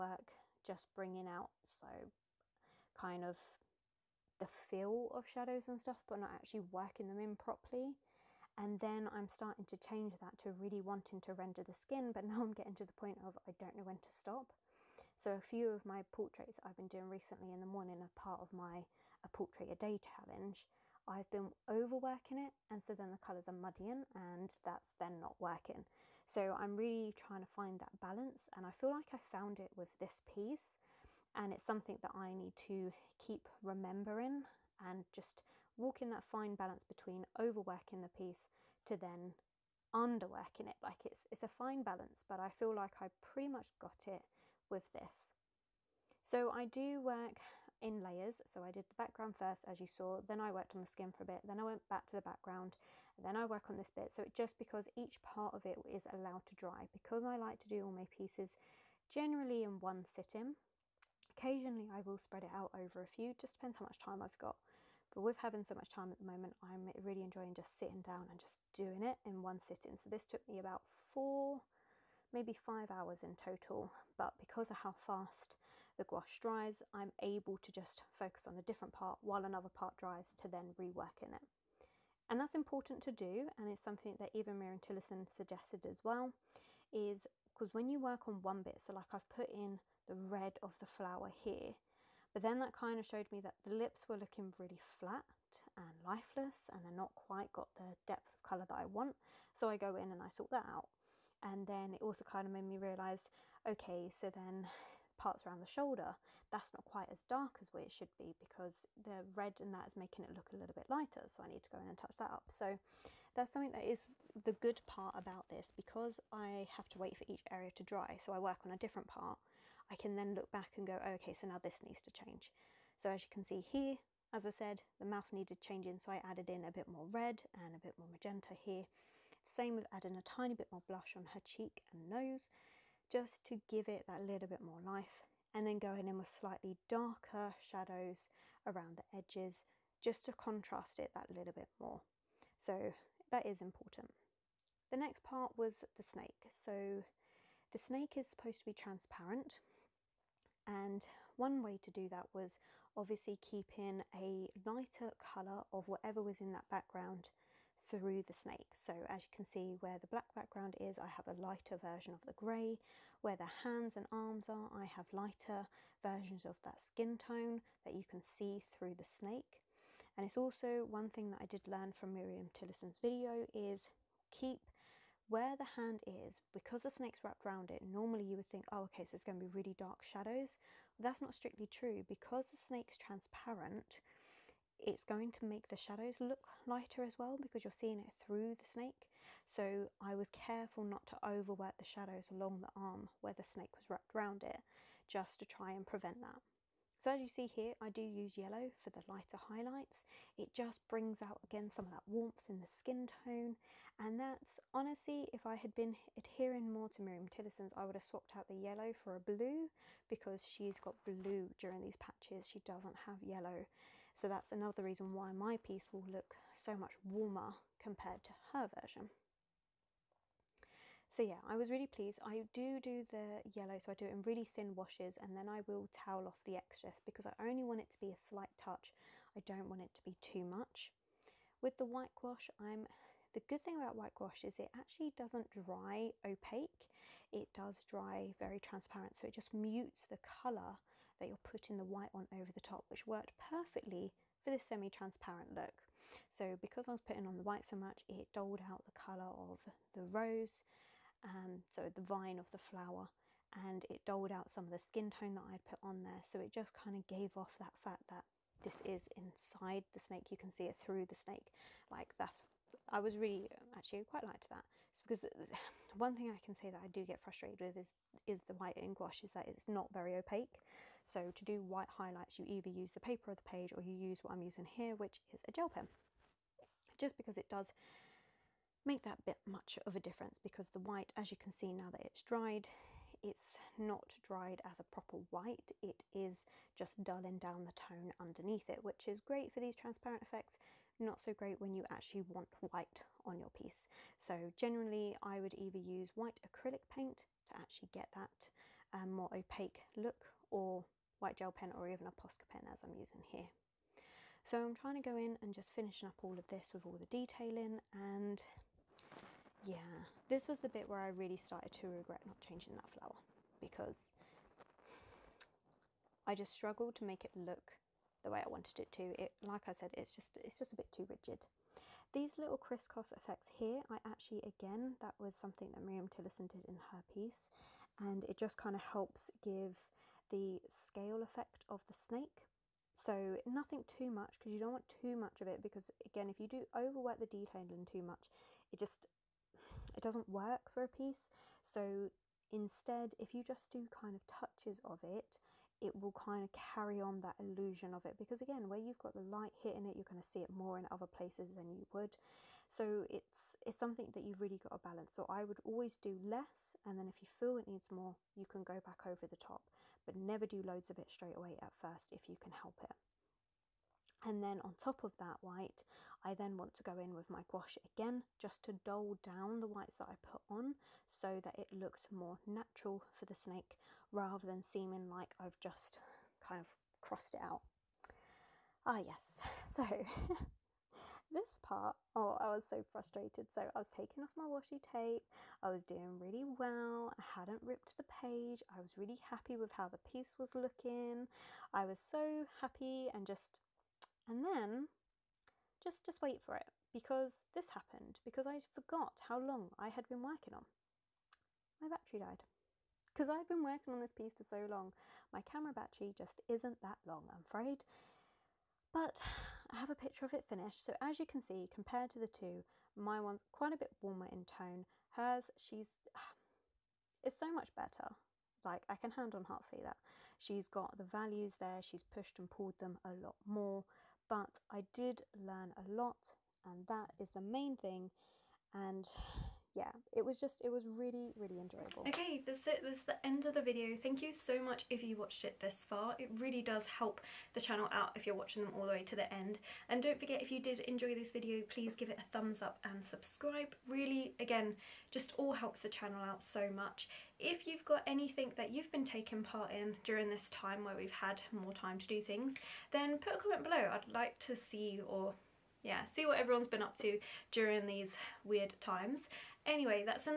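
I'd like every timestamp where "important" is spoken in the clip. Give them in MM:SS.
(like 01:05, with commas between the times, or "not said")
01:22, 02:23.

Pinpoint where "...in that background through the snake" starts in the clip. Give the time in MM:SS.
02:36.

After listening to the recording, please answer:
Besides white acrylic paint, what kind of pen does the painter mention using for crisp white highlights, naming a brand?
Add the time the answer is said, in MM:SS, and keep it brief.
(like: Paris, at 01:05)
Posca pen, at 05:02.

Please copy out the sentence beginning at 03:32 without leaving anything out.
She doesn't have yellow so that's another reason why my piece will look so much warmer compared to her version.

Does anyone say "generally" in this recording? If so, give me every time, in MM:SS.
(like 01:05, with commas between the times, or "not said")
00:59, 04:54.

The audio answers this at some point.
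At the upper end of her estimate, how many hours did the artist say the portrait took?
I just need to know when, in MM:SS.
01:12.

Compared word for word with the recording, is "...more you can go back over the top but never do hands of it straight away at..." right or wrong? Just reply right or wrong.
wrong.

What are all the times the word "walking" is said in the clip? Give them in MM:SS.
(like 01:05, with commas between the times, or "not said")
00:35.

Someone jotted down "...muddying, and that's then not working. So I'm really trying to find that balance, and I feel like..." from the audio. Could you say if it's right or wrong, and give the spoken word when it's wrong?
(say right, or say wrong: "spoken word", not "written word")
right.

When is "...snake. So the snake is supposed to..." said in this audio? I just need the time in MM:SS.
02:26.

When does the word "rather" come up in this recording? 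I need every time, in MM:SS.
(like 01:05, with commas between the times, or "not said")
06:14.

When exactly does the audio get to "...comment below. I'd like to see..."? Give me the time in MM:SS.
07:33.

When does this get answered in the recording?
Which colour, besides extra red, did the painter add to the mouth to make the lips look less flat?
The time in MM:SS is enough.
02:08.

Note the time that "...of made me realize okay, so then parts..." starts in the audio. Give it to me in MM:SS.
01:42.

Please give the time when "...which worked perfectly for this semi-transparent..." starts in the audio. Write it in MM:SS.
04:02.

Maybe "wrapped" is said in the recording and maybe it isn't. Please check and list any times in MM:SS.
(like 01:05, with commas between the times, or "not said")
02:57, 03:13.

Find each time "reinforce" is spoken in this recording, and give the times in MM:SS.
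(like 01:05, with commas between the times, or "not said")
not said.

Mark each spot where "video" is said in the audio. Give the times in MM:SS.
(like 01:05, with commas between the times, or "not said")
02:53, 07:13, 07:21.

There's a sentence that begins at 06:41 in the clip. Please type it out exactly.
My battery died because I'd been working on this piece for so long.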